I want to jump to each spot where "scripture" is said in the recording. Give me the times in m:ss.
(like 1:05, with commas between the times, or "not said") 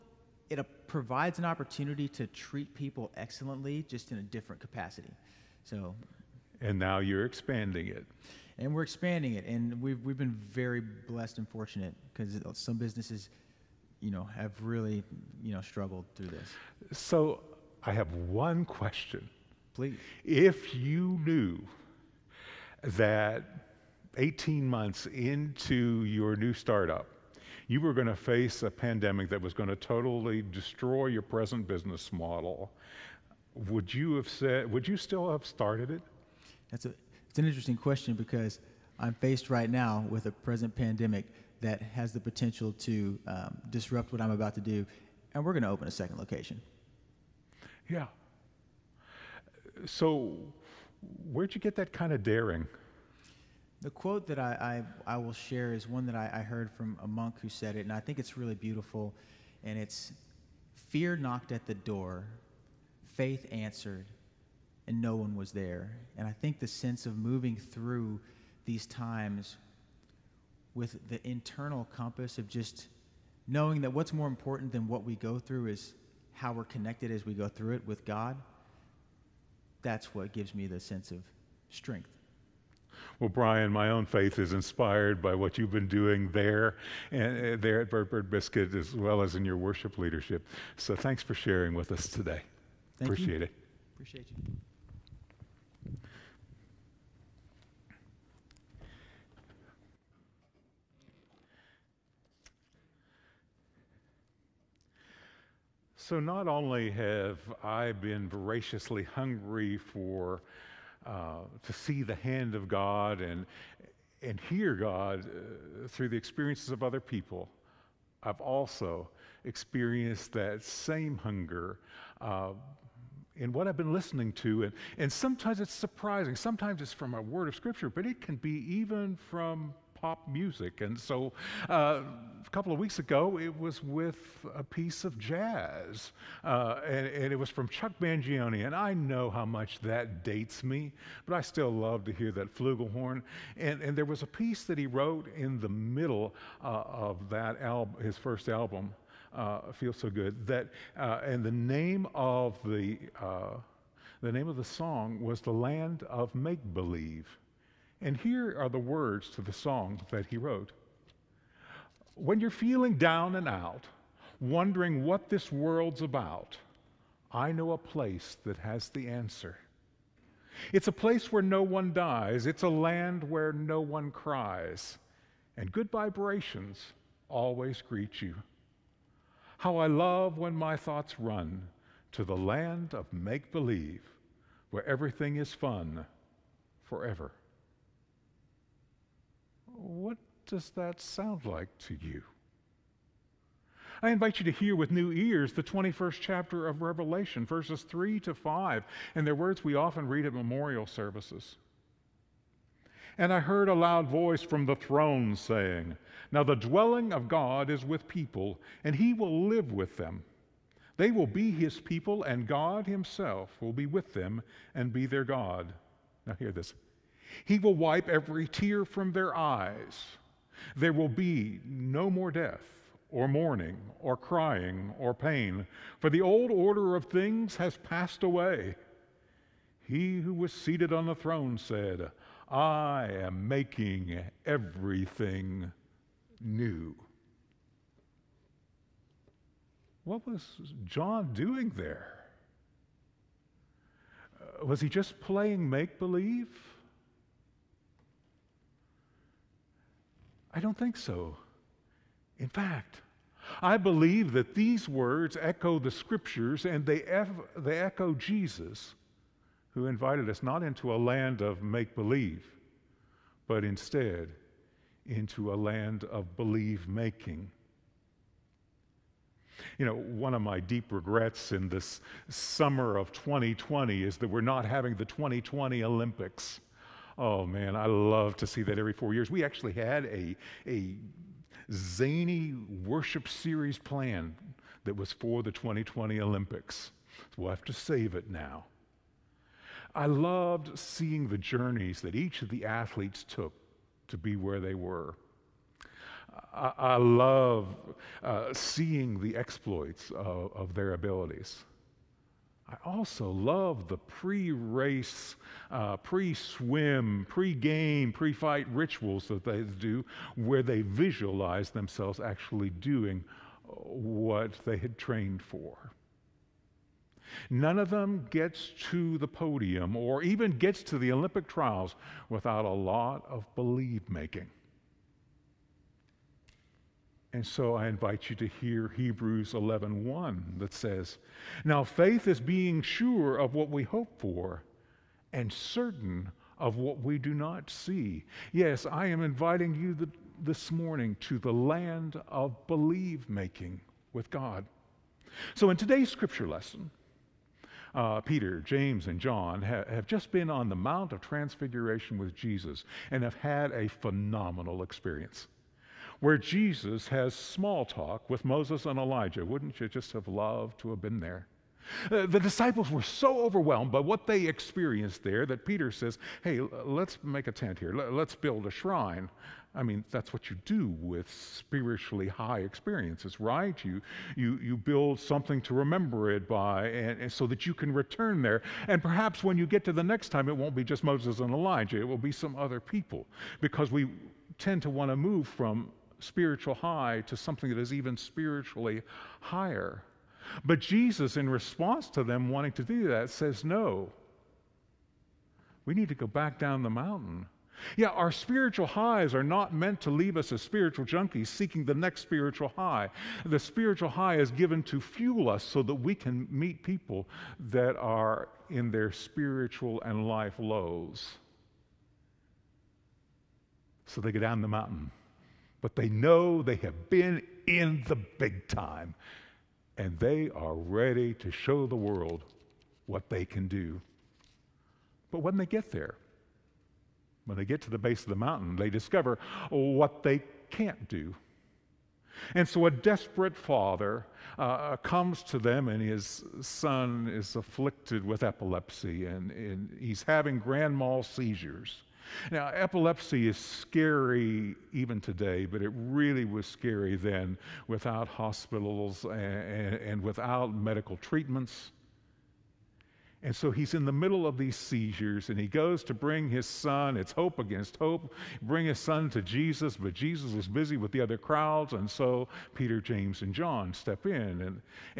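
2:07, 4:15, 5:46.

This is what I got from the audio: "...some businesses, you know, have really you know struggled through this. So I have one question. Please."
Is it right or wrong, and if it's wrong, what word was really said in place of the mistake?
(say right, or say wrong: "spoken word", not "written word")
right.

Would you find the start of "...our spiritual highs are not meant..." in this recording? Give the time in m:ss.
6:38.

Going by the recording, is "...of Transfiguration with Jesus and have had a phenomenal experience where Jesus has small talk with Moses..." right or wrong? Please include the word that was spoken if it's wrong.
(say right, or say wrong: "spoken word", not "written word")
right.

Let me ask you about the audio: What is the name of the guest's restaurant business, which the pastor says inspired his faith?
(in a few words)
Bird Bird Biscuit.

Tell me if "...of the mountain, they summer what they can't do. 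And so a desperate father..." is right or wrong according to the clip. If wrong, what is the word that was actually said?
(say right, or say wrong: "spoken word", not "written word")
wrong: "discover", not "summer".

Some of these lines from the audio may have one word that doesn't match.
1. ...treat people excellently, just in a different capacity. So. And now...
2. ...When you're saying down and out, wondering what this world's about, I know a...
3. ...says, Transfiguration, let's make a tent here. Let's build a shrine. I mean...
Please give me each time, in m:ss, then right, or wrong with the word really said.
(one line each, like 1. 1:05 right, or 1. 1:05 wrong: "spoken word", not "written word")
1. 0:02 right
2. 2:42 wrong: "feeling", not "saying"
3. 6:05 wrong: "Hey", not "Transfiguration".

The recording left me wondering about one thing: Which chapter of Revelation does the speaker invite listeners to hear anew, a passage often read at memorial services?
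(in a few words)
21st chapter.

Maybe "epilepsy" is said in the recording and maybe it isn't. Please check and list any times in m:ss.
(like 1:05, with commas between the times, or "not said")
7:18, 7:22.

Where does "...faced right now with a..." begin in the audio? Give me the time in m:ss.
0:39.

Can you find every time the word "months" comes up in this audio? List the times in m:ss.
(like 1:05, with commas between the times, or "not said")
0:24.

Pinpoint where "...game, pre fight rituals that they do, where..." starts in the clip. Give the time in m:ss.
5:07.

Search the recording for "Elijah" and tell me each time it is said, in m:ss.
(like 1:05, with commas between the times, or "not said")
5:58, 6:21.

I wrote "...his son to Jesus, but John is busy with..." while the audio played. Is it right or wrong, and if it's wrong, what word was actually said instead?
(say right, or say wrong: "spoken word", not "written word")
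wrong: "Jesus", not "John".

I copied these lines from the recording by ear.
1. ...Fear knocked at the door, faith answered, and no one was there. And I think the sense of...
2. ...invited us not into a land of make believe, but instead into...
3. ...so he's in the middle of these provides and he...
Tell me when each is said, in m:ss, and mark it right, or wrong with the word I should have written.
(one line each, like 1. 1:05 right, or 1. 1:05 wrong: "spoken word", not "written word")
1. 1:00 right
2. 4:19 right
3. 7:33 wrong: "seizures", not "provides".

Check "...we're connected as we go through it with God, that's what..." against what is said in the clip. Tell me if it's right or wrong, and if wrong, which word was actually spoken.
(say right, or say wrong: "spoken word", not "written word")
right.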